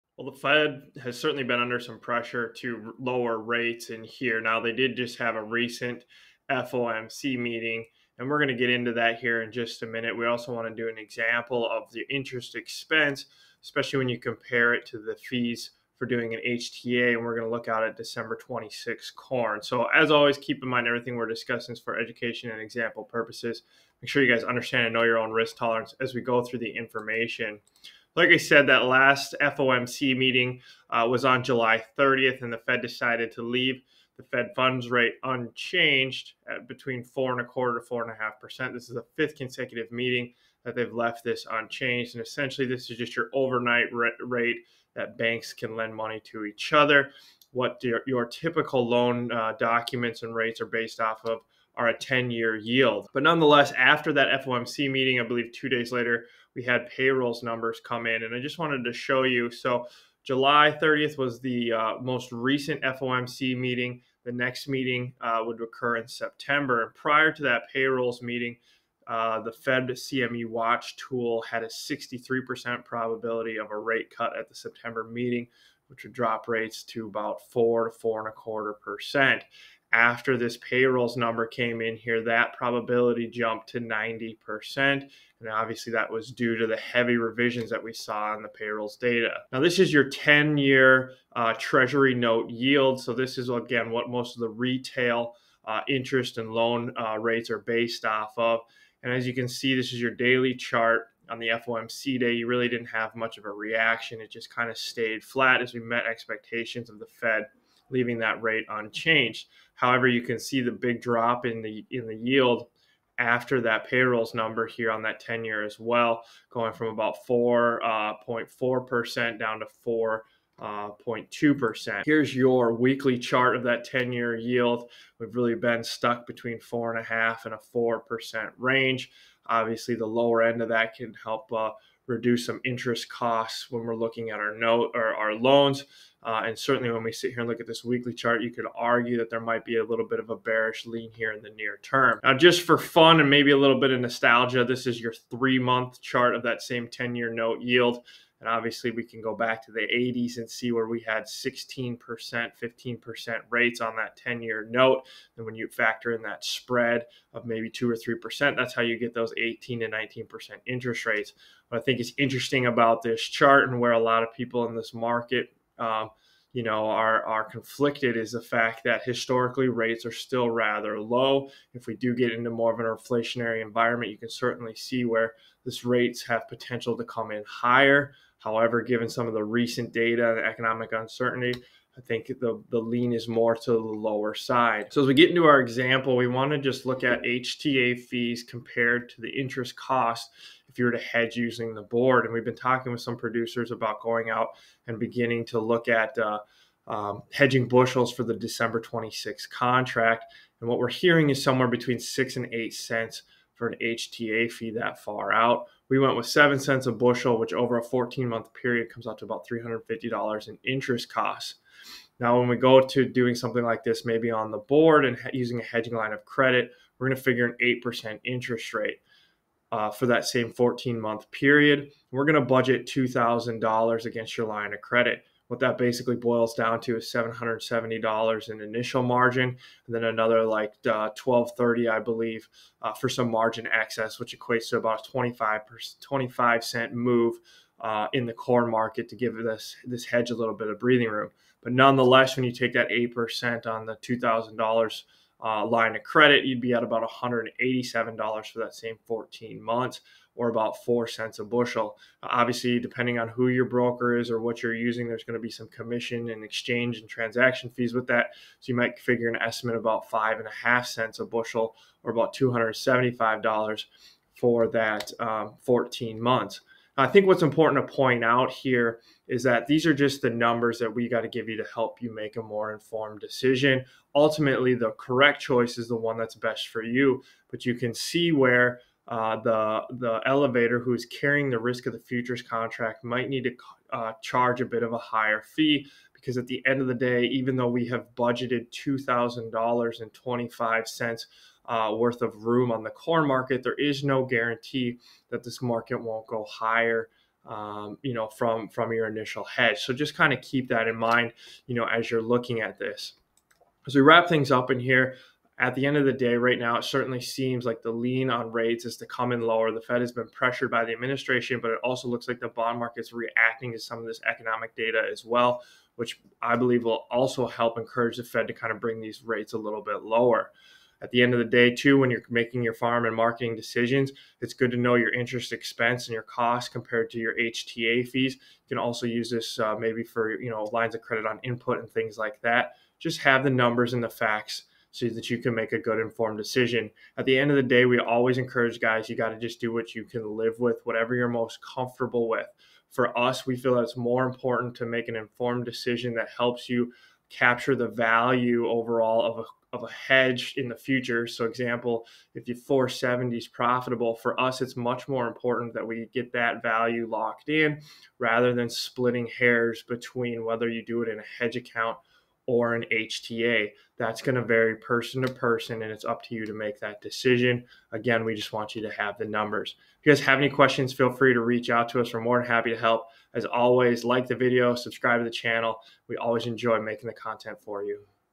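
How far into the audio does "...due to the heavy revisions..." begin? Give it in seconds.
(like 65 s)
86 s.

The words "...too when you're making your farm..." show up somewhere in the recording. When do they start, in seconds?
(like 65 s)
321 s.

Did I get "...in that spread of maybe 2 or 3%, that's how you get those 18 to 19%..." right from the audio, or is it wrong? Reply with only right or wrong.
right.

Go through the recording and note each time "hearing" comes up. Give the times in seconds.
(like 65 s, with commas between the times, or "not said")
200 s.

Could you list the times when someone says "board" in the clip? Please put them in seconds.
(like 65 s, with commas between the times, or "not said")
191 s, 214 s.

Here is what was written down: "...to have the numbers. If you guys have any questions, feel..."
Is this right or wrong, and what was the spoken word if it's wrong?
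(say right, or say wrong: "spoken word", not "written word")
right.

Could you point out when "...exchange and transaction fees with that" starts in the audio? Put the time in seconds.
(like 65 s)
256 s.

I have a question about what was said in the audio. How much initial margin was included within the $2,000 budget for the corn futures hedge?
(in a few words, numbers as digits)
$770.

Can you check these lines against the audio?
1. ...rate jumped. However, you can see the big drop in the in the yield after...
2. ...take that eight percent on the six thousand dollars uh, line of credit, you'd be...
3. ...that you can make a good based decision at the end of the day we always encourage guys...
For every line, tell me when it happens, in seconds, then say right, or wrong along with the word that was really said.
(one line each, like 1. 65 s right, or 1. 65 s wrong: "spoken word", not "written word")
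1. 108 s wrong: "unchanged", not "jumped"
2. 242 s wrong: "two", not "six"
3. 335 s wrong: "informed", not "based".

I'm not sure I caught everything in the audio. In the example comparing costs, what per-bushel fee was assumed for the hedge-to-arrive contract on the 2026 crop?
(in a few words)
7 cents.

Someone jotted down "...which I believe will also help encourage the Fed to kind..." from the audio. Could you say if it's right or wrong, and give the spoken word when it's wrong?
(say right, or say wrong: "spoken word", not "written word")
right.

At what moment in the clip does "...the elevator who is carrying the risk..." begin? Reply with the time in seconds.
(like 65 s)
279 s.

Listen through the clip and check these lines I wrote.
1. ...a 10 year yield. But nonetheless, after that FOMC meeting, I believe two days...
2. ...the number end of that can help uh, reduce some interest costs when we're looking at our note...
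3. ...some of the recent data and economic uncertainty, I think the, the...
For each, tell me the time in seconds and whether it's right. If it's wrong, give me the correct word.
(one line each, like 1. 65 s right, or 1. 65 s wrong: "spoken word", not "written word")
1. 51 s right
2. 129 s wrong: "lower", not "number"
3. 179 s right.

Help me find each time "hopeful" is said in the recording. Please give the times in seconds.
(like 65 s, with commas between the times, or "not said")
not said.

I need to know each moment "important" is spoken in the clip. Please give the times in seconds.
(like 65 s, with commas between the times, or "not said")
267 s, 344 s, 355 s.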